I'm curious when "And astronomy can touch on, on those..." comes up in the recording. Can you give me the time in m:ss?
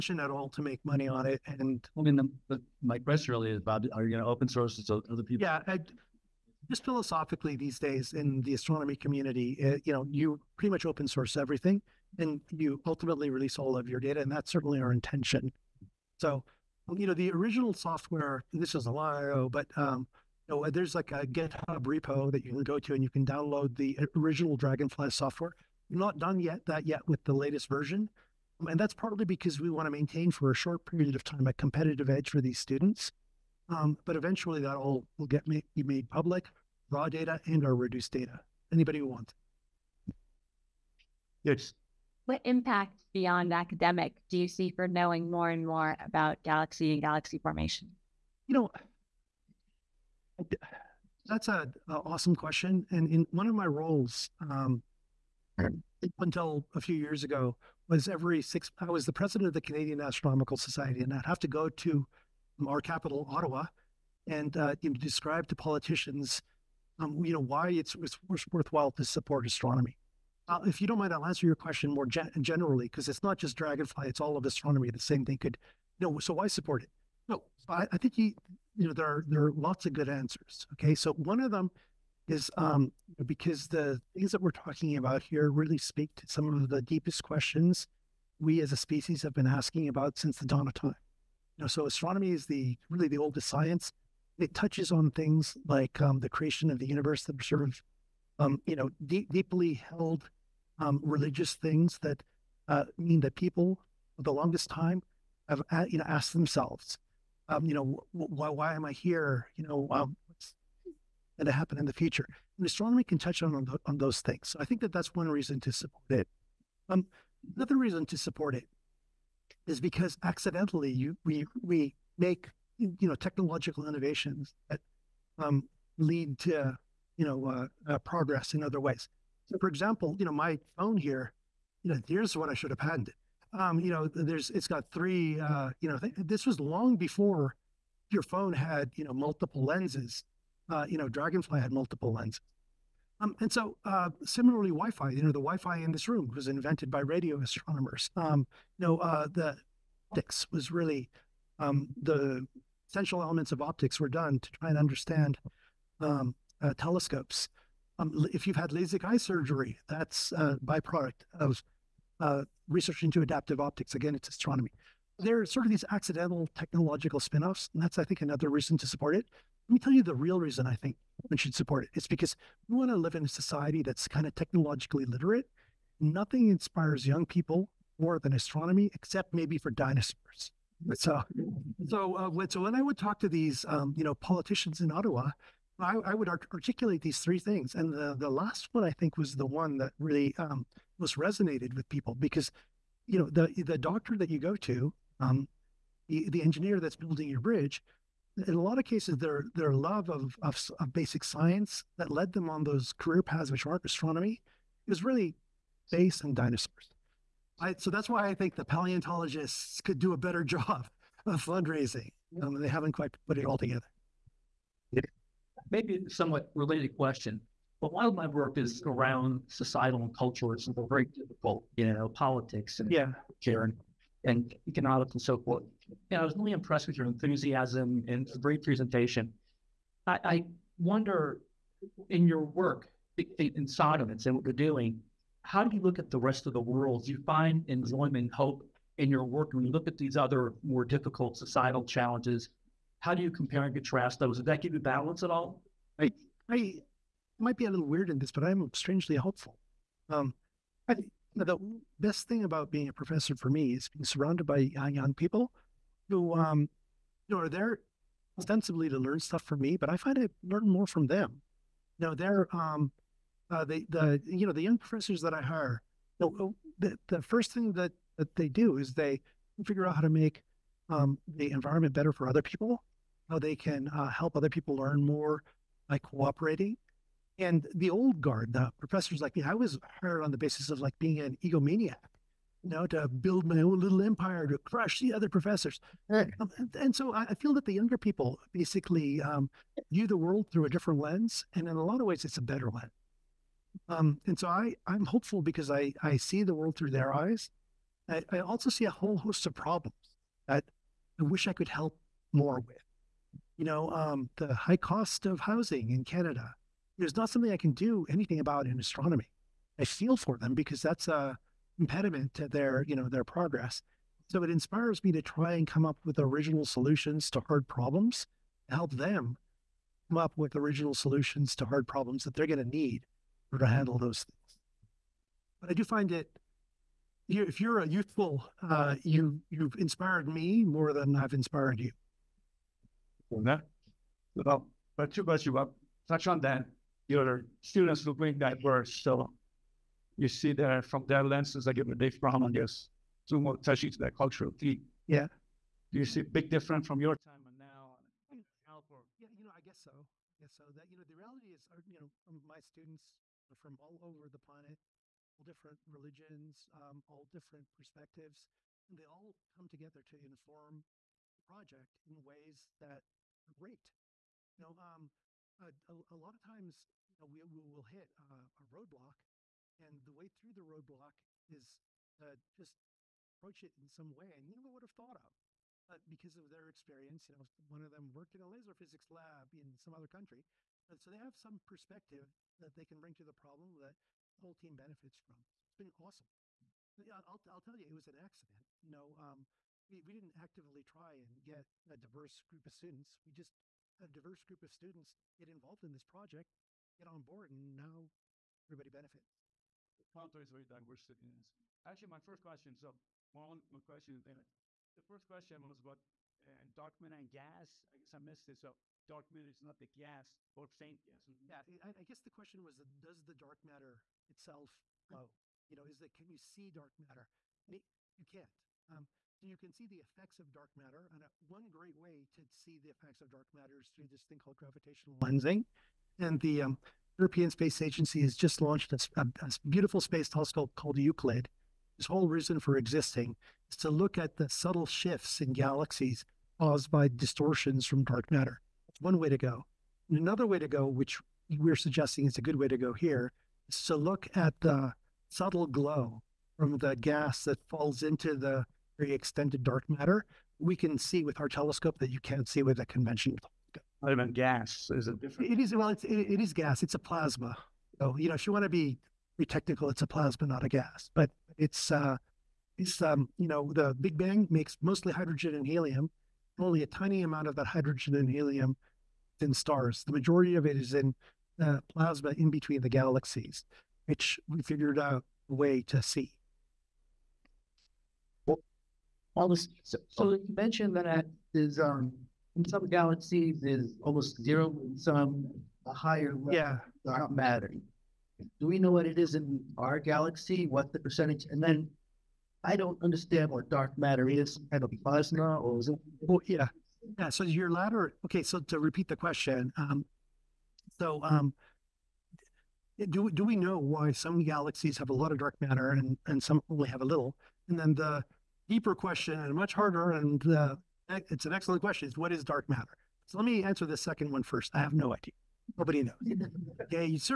1:52.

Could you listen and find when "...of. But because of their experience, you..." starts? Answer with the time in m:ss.
6:15.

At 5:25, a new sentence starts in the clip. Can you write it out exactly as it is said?
But I do find it, if you're a youthful, uh, you you've inspired me more than I've inspired you.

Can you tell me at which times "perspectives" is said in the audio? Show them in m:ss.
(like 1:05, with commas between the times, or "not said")
5:57, 6:21.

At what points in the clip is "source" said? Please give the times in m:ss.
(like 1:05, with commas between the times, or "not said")
0:04, 0:11.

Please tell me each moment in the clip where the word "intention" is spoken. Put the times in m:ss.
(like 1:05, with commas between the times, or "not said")
0:14.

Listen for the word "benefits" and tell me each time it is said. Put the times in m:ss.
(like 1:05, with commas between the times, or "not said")
6:24, 6:38.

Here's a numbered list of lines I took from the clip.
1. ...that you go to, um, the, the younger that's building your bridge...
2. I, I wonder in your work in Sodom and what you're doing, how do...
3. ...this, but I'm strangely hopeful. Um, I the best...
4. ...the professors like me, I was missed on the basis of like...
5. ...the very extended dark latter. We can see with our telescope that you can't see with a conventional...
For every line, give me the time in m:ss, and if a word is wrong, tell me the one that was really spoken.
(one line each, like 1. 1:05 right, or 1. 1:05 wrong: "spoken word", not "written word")
1. 3:14 wrong: "engineer", not "younger"
2. 3:50 right
3. 4:08 right
4. 4:38 wrong: "hired", not "missed"
5. 7:28 wrong: "matter", not "latter".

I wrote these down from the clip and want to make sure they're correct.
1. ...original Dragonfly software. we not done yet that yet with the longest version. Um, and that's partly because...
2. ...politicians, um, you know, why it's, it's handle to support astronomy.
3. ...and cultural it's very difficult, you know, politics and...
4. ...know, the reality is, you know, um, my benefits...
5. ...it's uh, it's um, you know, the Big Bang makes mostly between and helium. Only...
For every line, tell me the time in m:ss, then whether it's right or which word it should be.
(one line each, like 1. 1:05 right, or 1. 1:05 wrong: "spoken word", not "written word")
1. 0:24 wrong: "latest", not "longest"
2. 1:05 wrong: "worthwhile", not "handle"
3. 3:40 right
4. 5:50 wrong: "students", not "benefits"
5. 7:41 wrong: "hydrogen", not "between".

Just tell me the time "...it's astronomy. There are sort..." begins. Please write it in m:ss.
2:44.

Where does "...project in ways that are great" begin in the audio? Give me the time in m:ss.
6:01.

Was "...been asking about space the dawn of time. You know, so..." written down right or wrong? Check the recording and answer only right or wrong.
wrong.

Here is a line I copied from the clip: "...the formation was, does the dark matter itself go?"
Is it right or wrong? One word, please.
wrong.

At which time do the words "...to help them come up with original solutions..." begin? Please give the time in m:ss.
5:18.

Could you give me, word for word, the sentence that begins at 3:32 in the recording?
Um, they haven't quite put it all together.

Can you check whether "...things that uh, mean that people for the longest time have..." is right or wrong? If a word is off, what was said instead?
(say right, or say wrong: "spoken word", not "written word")
right.